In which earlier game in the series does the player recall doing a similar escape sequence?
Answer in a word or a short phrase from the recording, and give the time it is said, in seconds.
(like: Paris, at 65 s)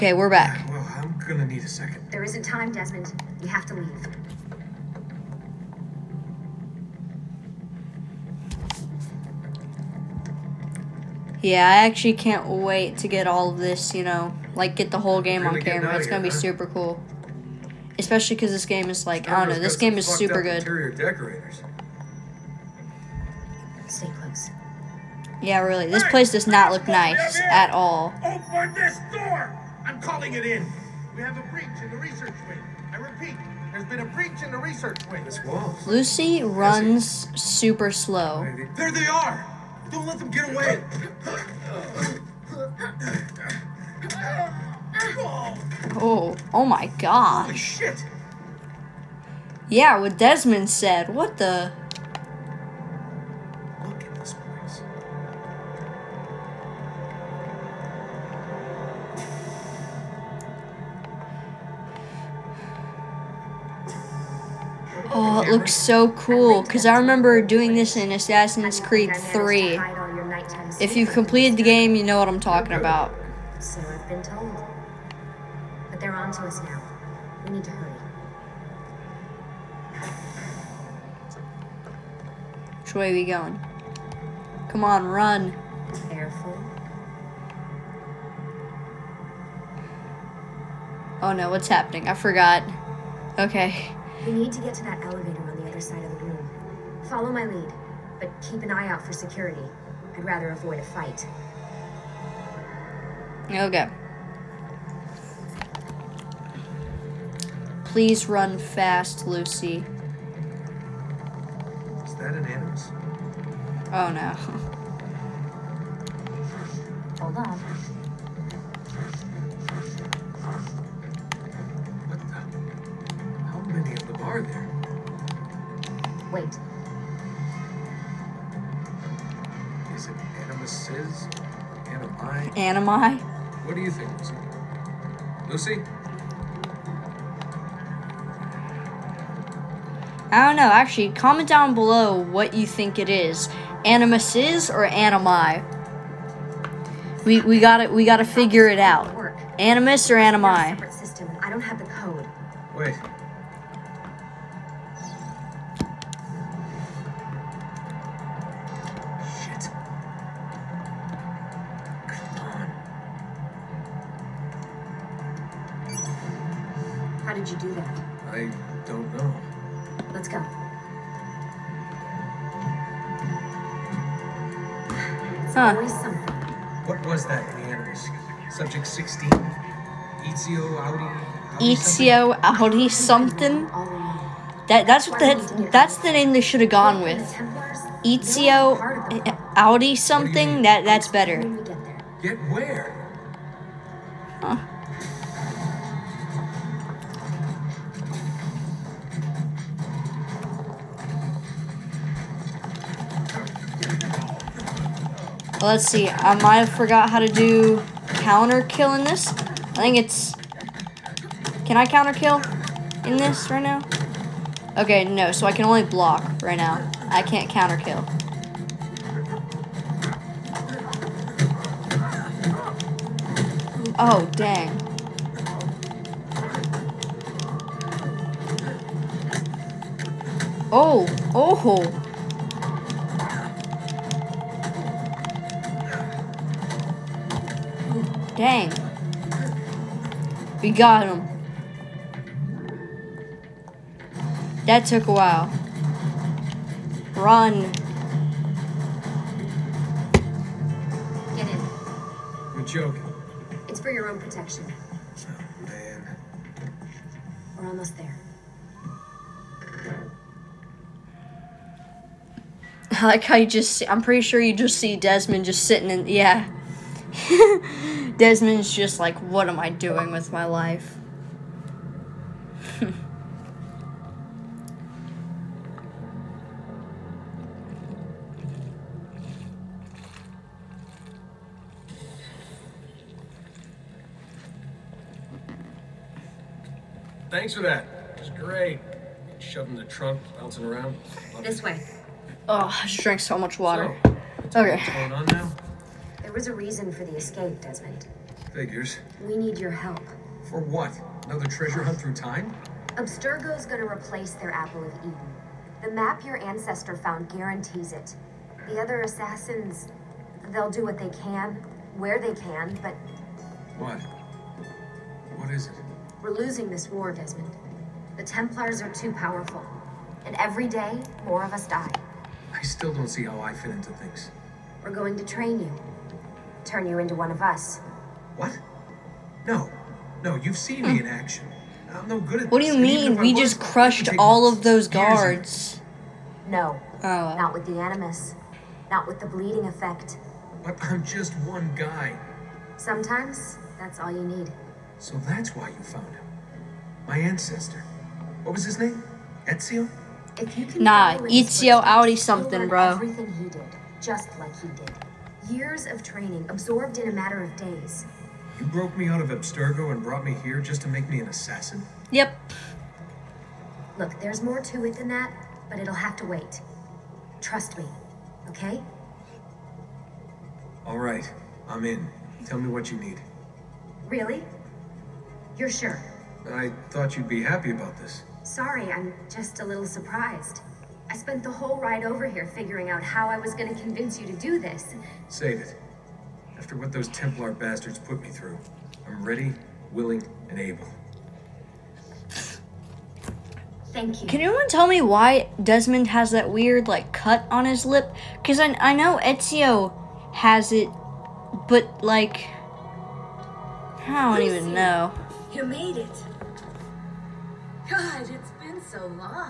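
Assassin's Creed 3, at 68 s.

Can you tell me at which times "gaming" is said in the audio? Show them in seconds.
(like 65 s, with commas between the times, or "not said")
not said.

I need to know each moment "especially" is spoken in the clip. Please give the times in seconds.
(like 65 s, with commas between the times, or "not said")
17 s.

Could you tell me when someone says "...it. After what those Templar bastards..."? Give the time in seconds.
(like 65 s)
385 s.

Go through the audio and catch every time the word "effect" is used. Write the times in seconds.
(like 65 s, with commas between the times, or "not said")
339 s.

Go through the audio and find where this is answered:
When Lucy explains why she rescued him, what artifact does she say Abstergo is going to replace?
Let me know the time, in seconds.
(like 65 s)
304 s.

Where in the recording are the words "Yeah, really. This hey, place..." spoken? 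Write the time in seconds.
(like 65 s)
25 s.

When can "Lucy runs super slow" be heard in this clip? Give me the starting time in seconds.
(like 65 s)
35 s.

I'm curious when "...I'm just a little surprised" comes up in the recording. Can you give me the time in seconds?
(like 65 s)
378 s.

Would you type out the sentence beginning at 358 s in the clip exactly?
You broke me out of Abstergo and brought me here just to make me an assassin?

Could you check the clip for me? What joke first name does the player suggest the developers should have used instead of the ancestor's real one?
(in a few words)
Horatio.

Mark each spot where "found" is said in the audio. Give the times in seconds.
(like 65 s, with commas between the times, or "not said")
306 s, 345 s.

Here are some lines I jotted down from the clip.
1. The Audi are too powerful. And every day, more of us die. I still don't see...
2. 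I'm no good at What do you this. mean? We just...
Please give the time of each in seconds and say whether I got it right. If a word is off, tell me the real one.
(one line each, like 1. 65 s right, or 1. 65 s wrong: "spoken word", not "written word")
1. 318 s wrong: "Templars", not "Audi"
2. 331 s right.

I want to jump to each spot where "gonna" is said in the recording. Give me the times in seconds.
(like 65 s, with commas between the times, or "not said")
16 s, 303 s.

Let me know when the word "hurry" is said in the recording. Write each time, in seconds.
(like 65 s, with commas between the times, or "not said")
77 s.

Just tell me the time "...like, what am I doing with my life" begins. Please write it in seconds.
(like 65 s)
268 s.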